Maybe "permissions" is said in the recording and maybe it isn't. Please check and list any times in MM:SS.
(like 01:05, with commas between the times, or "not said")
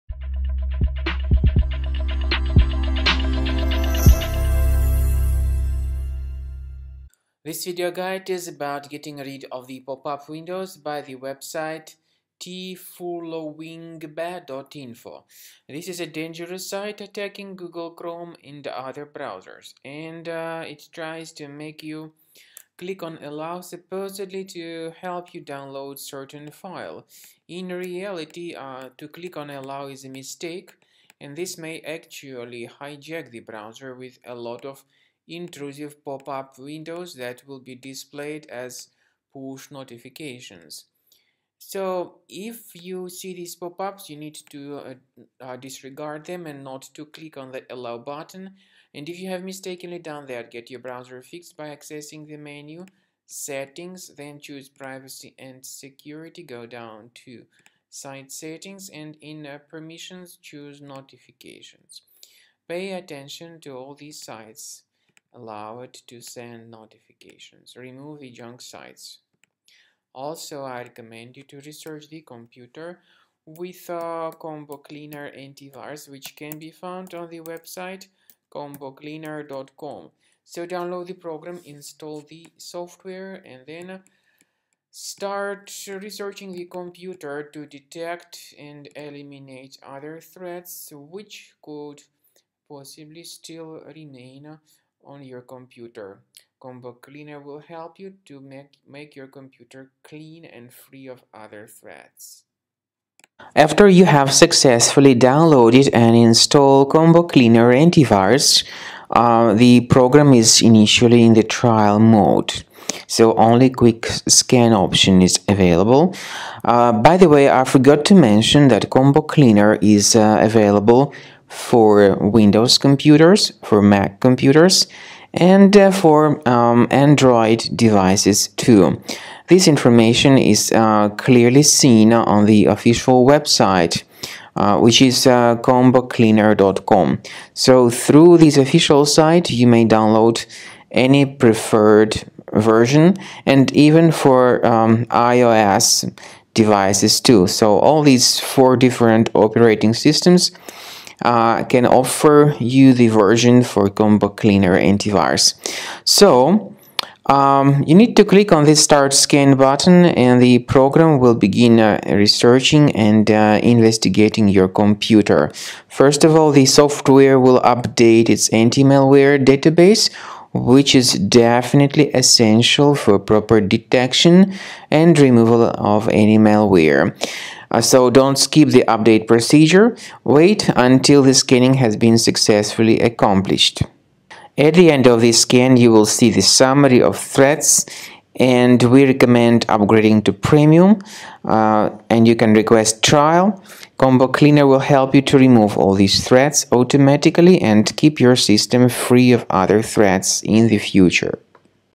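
00:59.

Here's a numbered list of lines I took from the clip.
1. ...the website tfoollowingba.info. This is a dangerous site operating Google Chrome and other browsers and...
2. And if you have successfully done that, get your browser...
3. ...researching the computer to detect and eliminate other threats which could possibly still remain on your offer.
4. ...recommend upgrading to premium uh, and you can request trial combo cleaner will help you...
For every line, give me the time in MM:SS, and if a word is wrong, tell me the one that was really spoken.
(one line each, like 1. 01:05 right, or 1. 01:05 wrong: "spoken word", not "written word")
1. 00:11 wrong: "attacking", not "operating"
2. 00:48 wrong: "mistakenly", not "successfully"
3. 01:25 wrong: "computer", not "offer"
4. 03:09 right.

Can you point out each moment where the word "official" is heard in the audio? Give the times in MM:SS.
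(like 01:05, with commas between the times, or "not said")
02:12, 02:18.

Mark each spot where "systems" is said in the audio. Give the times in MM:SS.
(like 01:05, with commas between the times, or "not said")
02:29, 03:18.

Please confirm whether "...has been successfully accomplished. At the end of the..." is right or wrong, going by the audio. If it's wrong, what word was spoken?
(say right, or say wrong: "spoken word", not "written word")
right.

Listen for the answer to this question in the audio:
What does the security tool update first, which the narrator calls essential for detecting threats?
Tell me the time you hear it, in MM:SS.
02:48.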